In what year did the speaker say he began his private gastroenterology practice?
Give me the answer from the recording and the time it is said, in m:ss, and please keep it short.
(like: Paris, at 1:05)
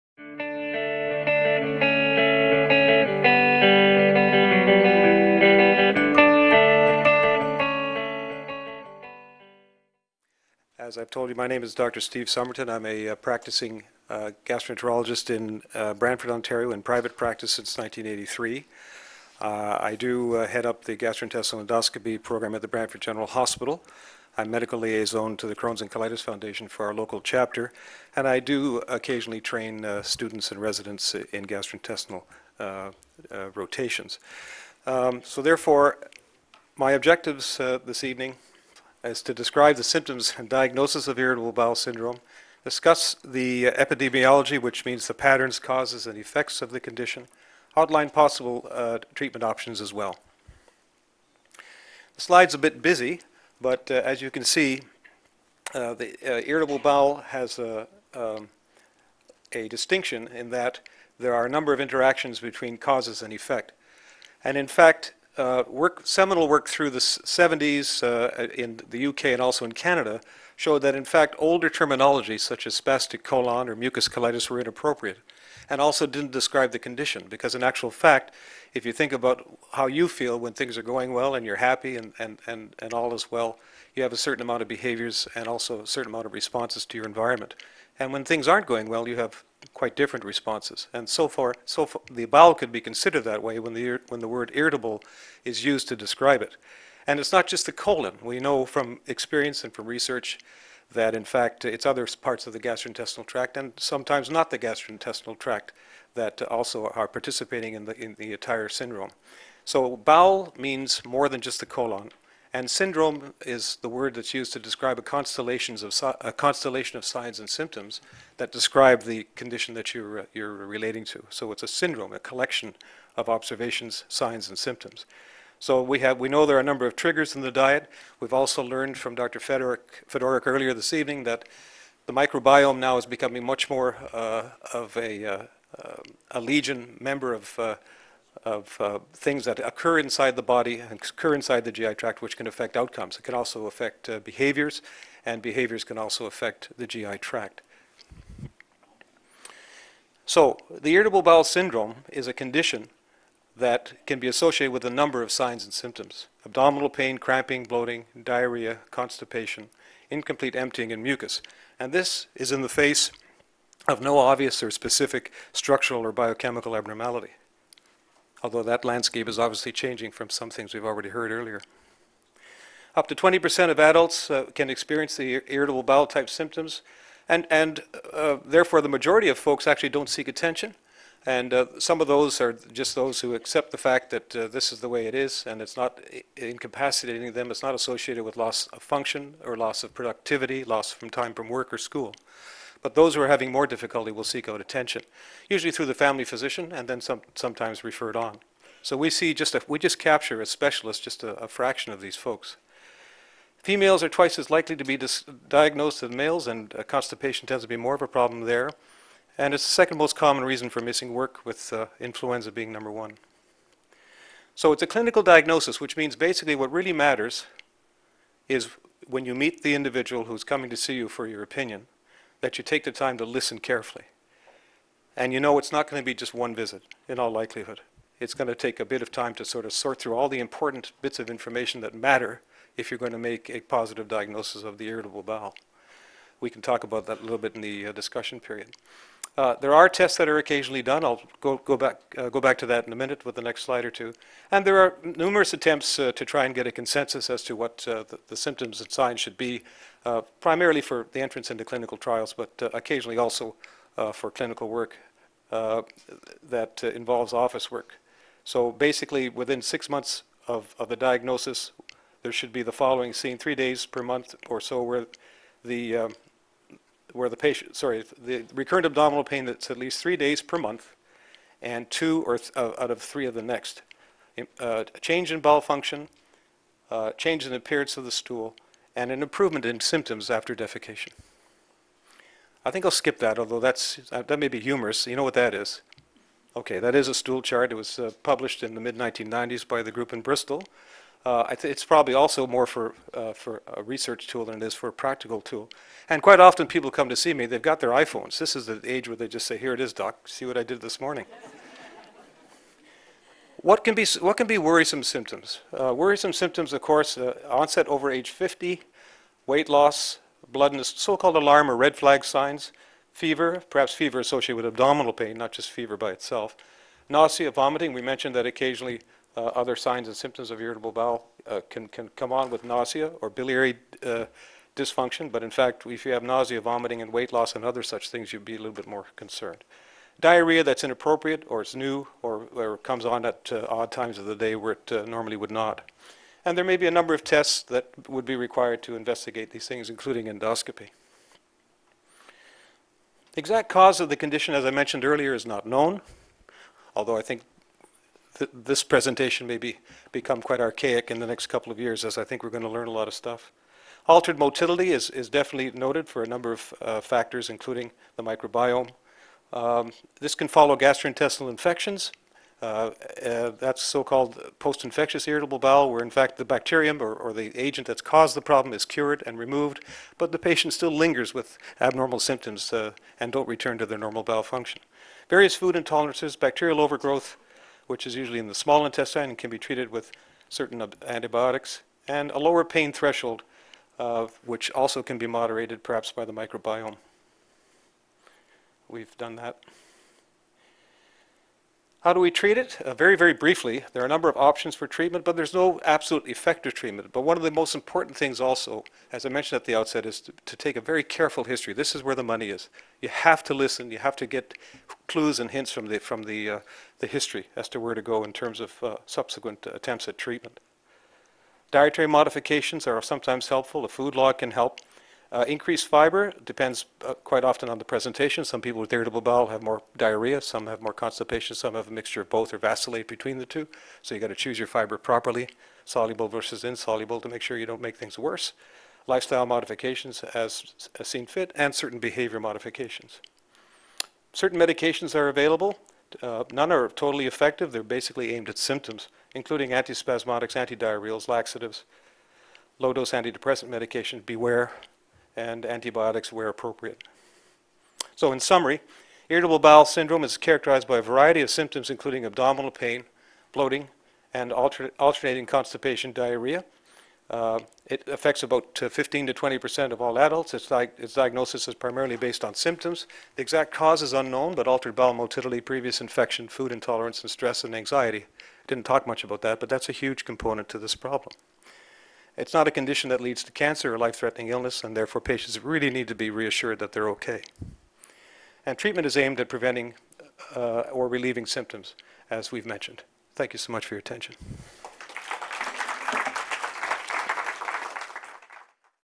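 1983, at 0:17.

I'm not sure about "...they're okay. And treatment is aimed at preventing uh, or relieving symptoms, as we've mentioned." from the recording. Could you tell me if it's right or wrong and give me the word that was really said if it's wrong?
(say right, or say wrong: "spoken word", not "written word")
right.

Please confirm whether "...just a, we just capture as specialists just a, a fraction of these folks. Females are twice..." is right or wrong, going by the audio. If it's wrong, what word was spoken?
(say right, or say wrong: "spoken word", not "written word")
right.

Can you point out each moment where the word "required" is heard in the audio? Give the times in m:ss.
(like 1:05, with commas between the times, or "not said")
5:38.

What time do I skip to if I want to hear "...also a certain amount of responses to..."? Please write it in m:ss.
1:25.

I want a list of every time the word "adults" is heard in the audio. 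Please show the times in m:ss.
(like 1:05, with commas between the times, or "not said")
2:53, 7:40.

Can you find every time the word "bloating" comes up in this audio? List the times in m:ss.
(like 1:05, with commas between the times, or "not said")
2:37, 7:33.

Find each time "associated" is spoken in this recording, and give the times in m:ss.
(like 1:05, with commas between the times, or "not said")
2:34, 3:07, 5:14.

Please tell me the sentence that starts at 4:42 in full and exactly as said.
I think I'll skip that, although that's, uh, that may be humorous.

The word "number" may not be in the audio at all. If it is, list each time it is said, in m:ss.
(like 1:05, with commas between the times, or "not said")
1:01, 2:06, 2:34, 3:32, 5:36, 5:56, 6:34.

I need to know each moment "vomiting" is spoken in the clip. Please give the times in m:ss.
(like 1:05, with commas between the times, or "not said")
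5:17, 5:26.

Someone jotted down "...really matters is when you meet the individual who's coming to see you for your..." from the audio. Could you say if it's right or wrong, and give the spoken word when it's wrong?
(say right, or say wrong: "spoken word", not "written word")
right.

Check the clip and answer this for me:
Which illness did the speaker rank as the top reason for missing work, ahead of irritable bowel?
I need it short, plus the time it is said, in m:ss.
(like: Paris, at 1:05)
influenza, at 3:31.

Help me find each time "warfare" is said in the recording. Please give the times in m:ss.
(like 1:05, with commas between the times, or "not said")
not said.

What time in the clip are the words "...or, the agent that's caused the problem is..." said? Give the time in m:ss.
6:07.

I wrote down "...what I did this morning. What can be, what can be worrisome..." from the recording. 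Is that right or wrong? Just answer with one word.
right.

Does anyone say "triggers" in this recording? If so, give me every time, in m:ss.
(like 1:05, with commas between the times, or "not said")
2:06.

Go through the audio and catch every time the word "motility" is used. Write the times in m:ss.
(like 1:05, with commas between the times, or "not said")
5:54, 7:45.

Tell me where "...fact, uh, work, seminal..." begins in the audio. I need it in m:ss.
1:04.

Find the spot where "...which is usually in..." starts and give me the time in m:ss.
6:17.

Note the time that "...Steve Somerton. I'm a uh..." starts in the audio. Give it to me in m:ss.
0:12.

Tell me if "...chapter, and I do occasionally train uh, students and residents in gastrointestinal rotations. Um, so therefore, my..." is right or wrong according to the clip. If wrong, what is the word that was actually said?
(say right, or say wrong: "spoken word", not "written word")
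right.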